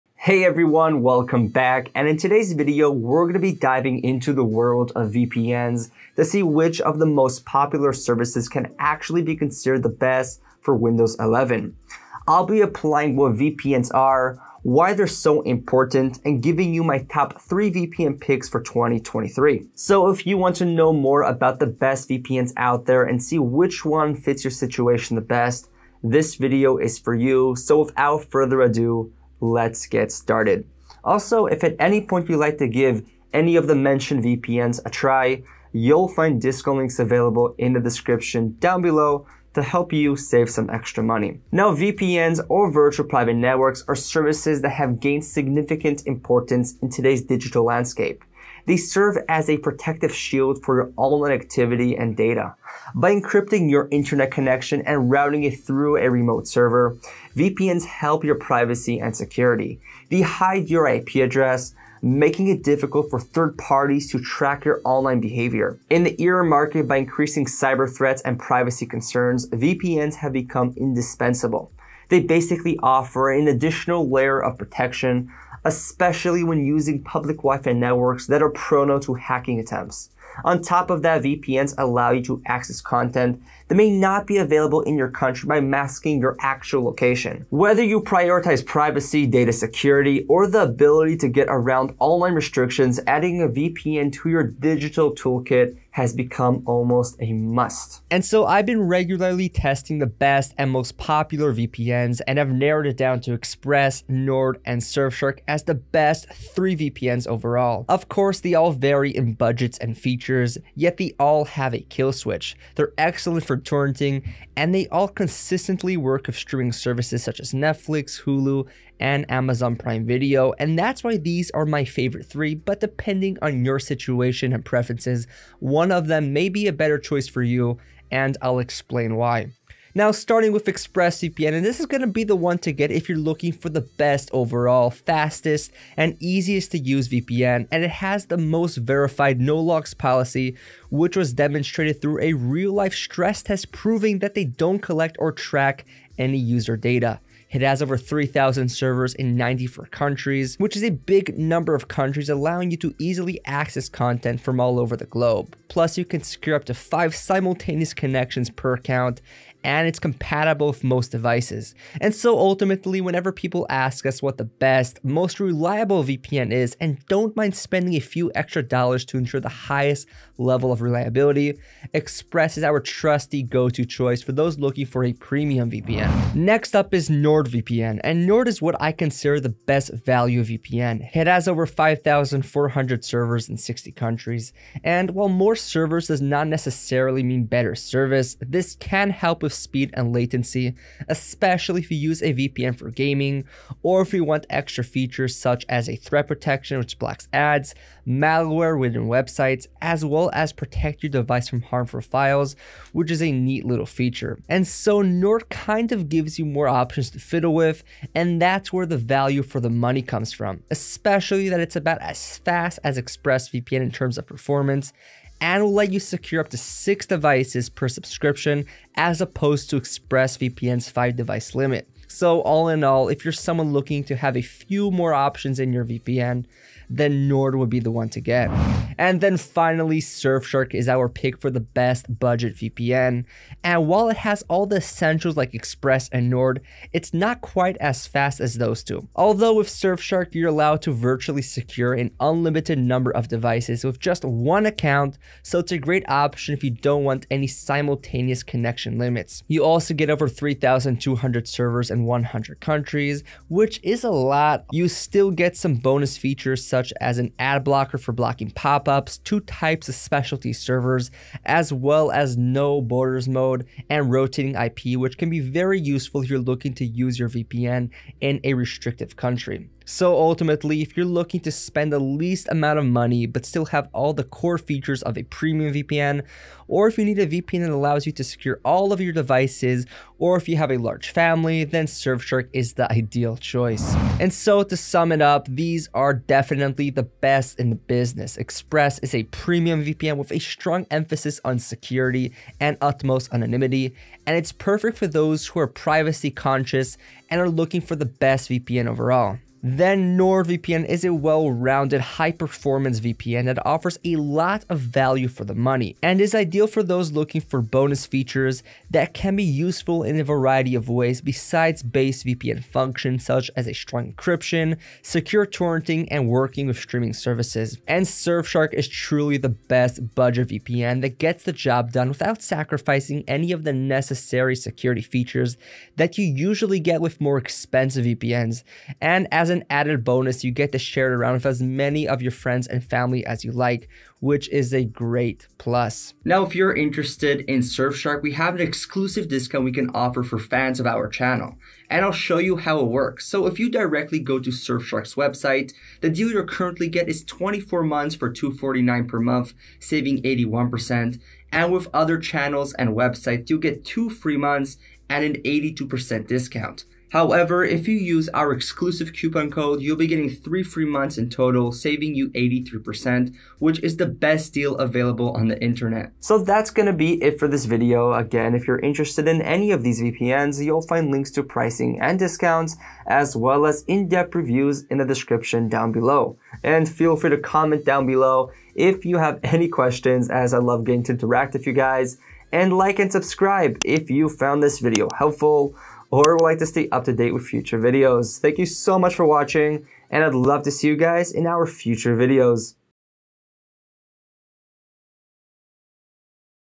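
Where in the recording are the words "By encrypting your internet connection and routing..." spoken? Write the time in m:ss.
0:52.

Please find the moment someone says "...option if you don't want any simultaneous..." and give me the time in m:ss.
4:06.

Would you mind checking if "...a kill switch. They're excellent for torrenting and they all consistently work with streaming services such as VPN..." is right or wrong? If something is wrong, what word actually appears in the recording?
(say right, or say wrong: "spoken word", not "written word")
wrong: "Netflix", not "VPN".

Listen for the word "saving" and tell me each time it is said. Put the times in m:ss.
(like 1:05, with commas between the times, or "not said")
5:49, 6:01.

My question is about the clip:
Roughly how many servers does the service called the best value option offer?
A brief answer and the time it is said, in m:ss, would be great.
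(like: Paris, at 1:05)
5,400, at 3:01.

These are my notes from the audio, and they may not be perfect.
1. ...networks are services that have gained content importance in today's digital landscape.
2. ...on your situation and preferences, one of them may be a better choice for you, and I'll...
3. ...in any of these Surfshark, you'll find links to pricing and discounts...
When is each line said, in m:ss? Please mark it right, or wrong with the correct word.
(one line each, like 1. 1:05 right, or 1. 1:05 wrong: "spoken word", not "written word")
1. 0:43 wrong: "significant", not "content"
2. 2:03 right
3. 6:09 wrong: "VPNs", not "Surfshark".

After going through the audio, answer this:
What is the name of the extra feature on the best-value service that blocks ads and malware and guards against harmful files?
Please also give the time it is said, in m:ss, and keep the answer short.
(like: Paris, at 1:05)
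Threat protection, at 3:15.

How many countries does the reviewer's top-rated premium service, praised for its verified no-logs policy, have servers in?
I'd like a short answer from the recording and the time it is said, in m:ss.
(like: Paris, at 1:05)
94, at 2:29.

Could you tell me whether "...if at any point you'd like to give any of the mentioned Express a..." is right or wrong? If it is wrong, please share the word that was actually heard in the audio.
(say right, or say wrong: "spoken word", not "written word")
wrong: "VPNs", not "Express".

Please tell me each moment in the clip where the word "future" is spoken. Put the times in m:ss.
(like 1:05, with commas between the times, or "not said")
6:27, 6:31.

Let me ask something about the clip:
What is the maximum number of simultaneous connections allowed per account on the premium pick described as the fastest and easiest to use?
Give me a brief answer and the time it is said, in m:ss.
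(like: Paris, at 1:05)
5, at 2:36.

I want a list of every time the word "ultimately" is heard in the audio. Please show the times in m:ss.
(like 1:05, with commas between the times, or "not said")
2:42, 4:30.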